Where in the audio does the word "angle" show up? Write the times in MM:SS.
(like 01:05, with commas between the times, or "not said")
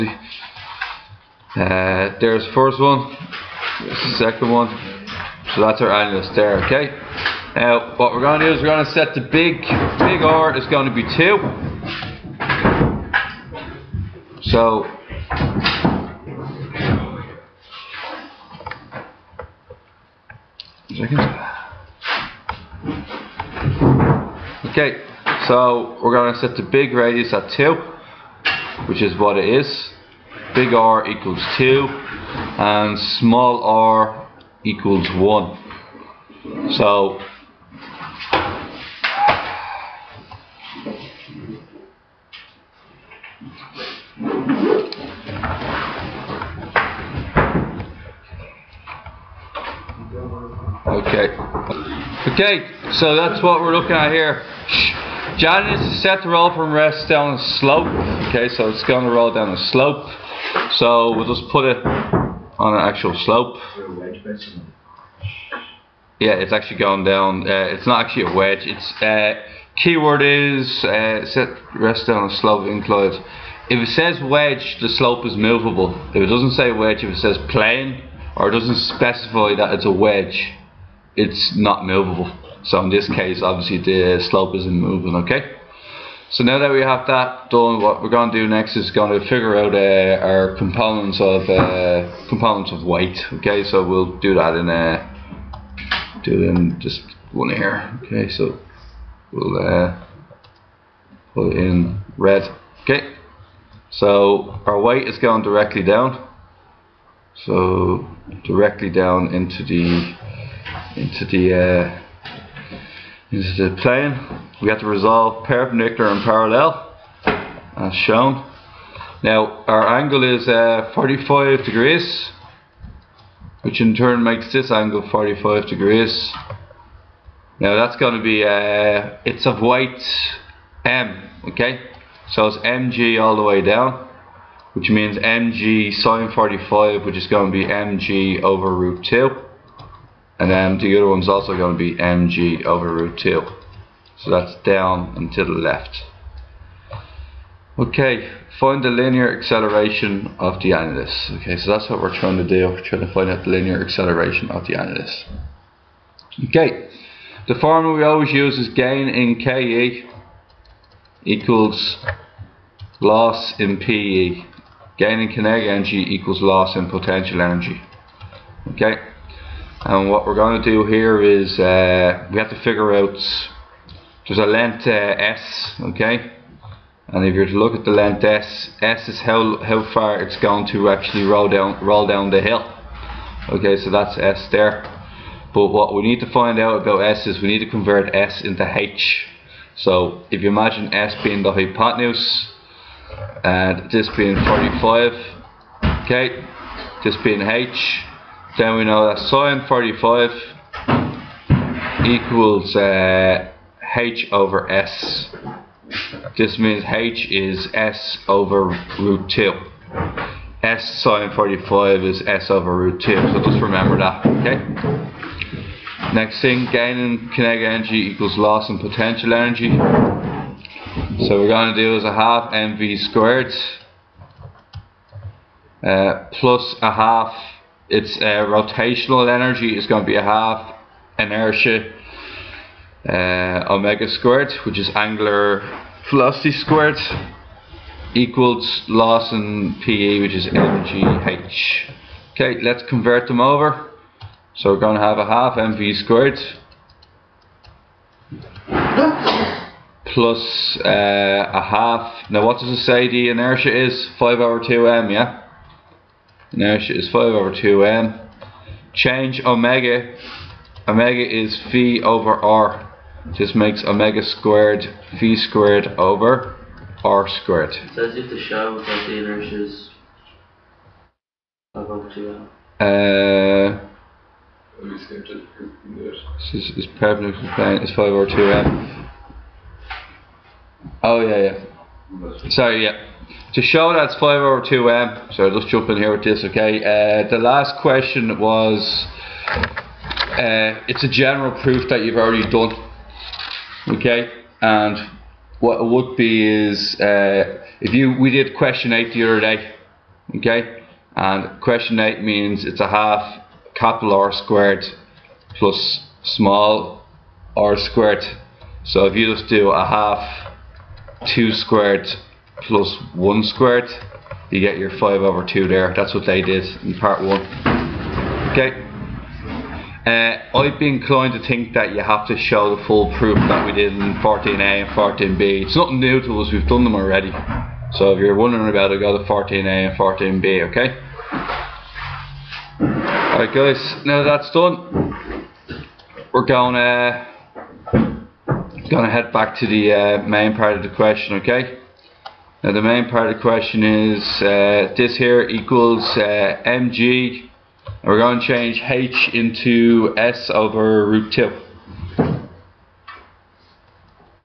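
01:59, 02:04.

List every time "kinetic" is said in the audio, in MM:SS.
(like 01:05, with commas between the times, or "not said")
02:45, 03:37.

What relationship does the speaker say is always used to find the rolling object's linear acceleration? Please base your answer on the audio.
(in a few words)
gain in KE equals loss in PE.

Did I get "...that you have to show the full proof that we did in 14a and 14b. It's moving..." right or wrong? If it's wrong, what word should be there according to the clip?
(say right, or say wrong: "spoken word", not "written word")
wrong: "nothing", not "moving".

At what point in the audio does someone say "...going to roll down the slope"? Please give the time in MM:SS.
00:58.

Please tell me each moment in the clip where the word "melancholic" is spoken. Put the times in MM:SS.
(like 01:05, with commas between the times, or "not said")
not said.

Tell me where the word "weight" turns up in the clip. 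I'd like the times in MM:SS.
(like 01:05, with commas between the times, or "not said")
01:32, 01:44, 02:09.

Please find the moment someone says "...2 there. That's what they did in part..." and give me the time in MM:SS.
05:15.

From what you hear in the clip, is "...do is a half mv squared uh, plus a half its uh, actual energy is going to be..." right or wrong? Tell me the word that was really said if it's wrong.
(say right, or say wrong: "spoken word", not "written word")
wrong: "rotational", not "actual".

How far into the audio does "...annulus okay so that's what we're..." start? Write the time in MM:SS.
02:30.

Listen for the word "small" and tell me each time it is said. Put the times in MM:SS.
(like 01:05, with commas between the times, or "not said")
00:33, 05:06.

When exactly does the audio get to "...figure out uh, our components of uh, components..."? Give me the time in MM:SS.
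01:29.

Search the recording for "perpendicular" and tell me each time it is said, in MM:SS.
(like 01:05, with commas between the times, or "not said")
01:55.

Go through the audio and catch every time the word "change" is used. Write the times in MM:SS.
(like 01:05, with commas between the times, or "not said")
04:18, 05:48.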